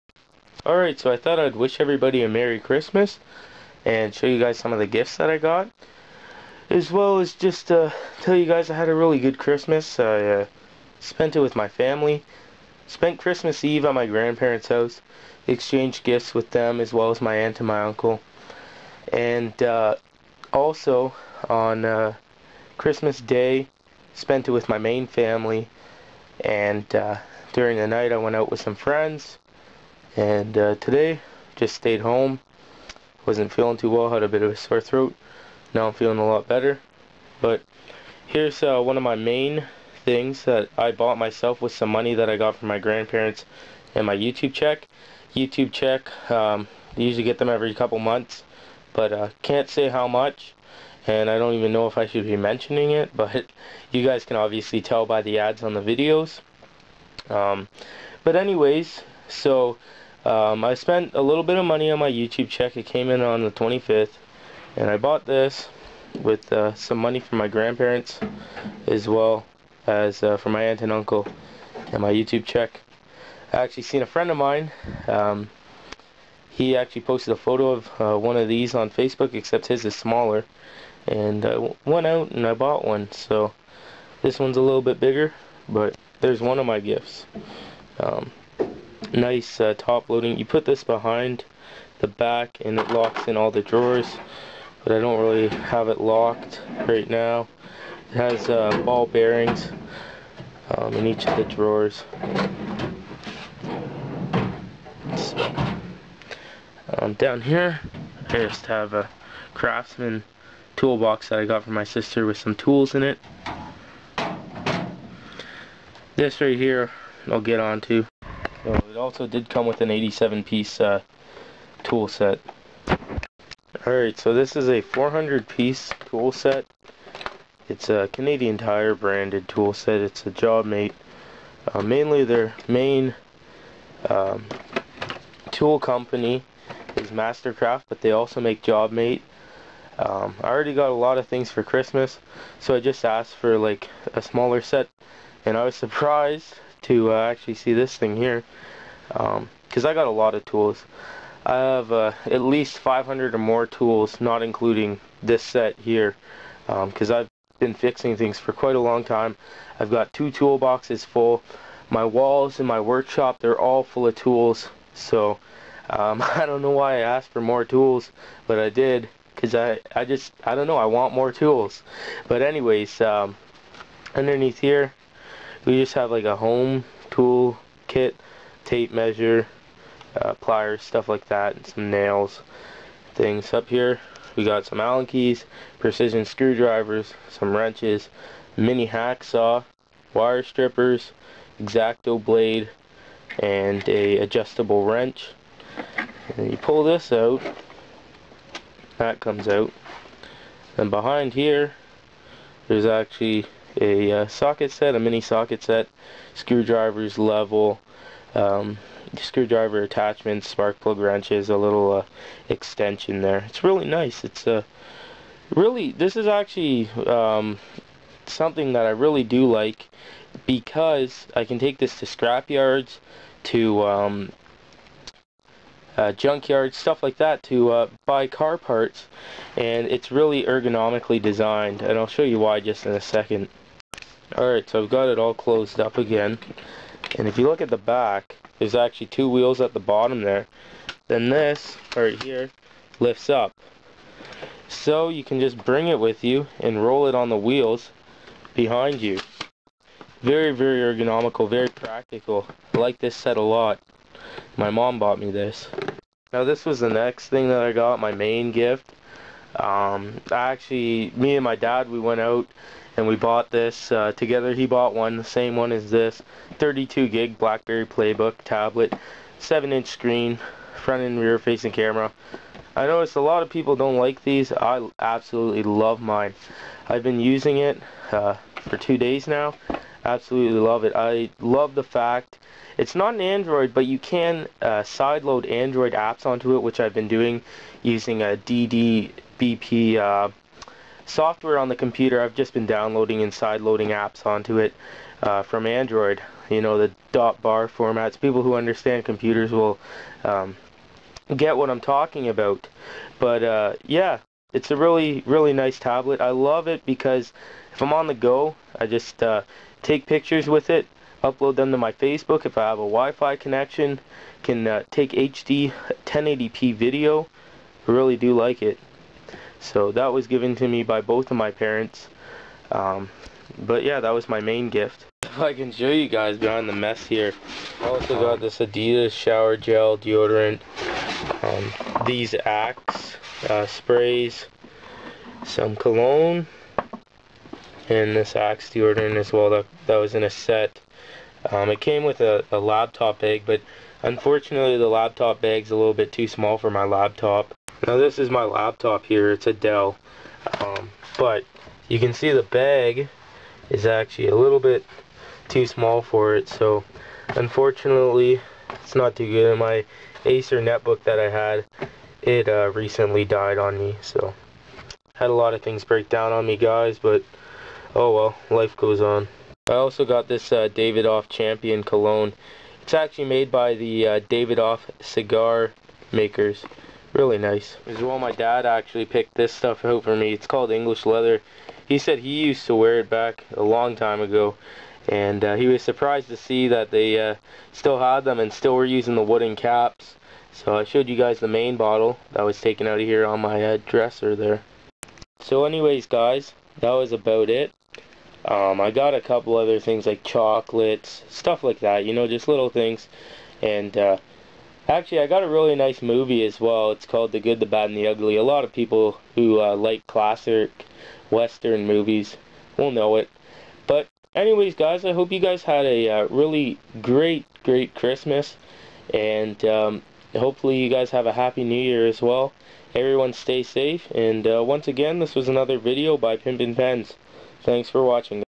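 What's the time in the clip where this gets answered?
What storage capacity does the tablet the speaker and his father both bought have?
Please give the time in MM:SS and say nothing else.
04:26.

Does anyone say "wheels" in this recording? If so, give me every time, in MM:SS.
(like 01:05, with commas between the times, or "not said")
03:59, 04:07.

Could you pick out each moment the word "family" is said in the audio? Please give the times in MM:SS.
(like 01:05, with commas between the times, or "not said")
00:11, 00:25.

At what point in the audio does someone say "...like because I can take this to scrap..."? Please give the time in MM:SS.
03:39.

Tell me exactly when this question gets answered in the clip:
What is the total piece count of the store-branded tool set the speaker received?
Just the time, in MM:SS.
02:04.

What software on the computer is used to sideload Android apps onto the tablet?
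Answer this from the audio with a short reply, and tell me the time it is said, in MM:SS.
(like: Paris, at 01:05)
DDBP, at 04:48.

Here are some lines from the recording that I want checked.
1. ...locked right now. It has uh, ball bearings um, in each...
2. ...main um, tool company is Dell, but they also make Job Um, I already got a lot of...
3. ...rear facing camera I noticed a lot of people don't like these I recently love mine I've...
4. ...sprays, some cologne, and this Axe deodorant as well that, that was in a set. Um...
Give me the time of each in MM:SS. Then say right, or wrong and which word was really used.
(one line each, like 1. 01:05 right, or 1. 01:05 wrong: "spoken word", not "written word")
1. 01:36 right
2. 02:12 wrong: "Mastercraft", not "Dell"
3. 04:31 wrong: "absolutely", not "recently"
4. 05:33 right.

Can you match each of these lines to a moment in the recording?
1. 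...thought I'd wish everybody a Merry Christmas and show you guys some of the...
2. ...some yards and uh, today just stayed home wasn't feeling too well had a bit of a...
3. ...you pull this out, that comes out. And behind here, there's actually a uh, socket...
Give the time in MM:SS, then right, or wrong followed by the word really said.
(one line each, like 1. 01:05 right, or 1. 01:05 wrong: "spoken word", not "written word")
1. 00:01 right
2. 00:28 wrong: "friends", not "yards"
3. 03:16 right.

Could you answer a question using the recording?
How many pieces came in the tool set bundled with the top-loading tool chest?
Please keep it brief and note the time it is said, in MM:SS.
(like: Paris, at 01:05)
87, at 01:59.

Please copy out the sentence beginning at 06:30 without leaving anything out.
So I showed you guys the main bottle that was taken out of here on my uh, dresser there.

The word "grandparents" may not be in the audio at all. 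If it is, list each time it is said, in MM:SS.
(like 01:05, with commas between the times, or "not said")
00:14, 00:42, 01:07.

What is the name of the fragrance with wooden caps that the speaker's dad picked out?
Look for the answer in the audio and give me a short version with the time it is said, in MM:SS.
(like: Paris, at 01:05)
English Leather, at 06:20.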